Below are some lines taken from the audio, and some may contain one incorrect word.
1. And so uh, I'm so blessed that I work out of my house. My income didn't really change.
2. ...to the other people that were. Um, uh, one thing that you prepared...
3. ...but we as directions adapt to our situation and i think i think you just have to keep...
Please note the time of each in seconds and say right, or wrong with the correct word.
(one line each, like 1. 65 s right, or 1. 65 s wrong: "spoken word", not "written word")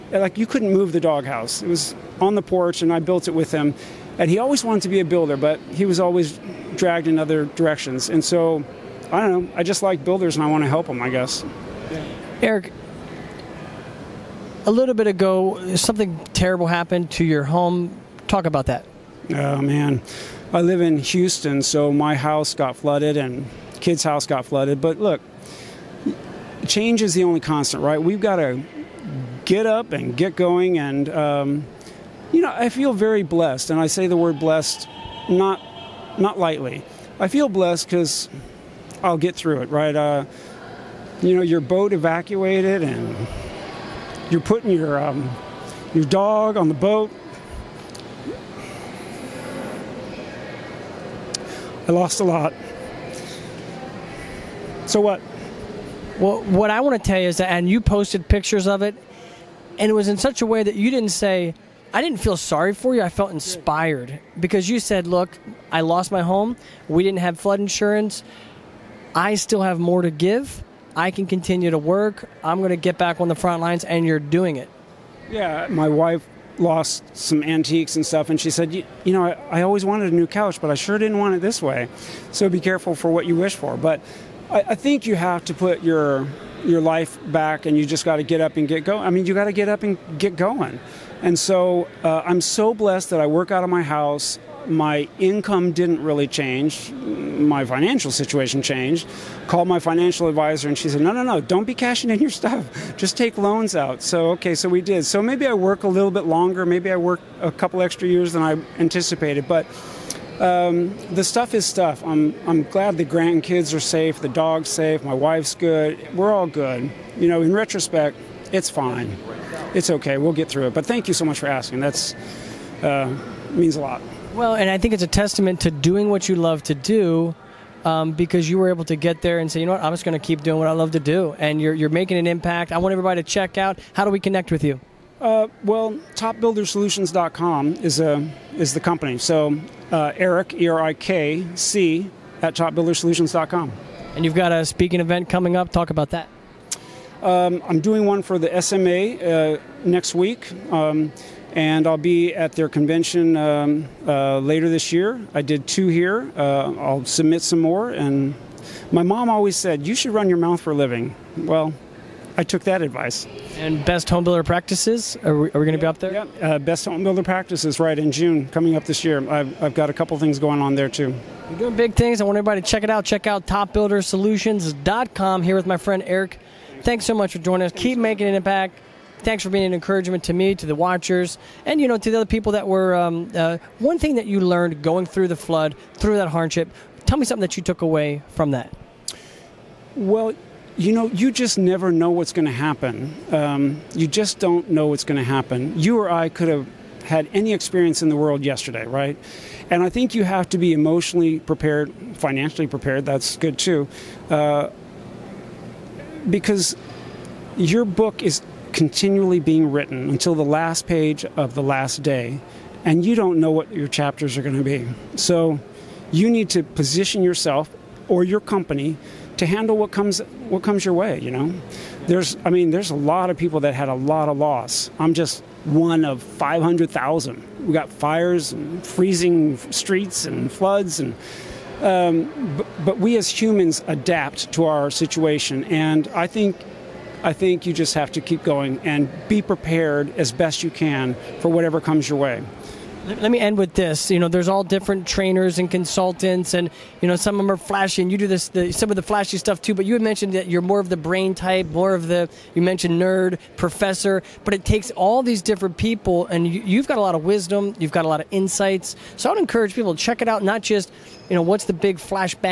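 1. 91 s right
2. 181 s wrong: "learned", not "prepared"
3. 232 s wrong: "humans", not "directions".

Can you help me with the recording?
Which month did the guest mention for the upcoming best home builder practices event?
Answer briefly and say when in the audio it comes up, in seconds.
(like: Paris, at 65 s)
June, at 168 s.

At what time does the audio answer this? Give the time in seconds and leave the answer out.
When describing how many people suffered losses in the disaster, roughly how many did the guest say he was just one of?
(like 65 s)
226 s.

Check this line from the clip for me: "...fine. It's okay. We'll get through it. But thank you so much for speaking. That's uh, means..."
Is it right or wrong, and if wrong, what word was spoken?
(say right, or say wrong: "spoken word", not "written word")
wrong: "asking", not "speaking".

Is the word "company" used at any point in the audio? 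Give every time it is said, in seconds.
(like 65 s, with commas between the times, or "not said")
138 s, 218 s.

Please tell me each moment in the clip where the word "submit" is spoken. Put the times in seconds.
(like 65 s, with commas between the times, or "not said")
157 s.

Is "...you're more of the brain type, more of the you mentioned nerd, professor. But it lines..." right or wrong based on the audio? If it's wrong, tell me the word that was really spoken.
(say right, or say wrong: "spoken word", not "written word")
wrong: "takes", not "lines".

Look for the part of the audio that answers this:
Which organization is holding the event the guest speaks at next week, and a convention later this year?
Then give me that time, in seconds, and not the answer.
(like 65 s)
148 s.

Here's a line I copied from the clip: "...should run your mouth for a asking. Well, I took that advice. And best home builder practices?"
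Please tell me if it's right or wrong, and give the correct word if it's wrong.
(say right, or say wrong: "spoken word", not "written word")
wrong: "living", not "asking".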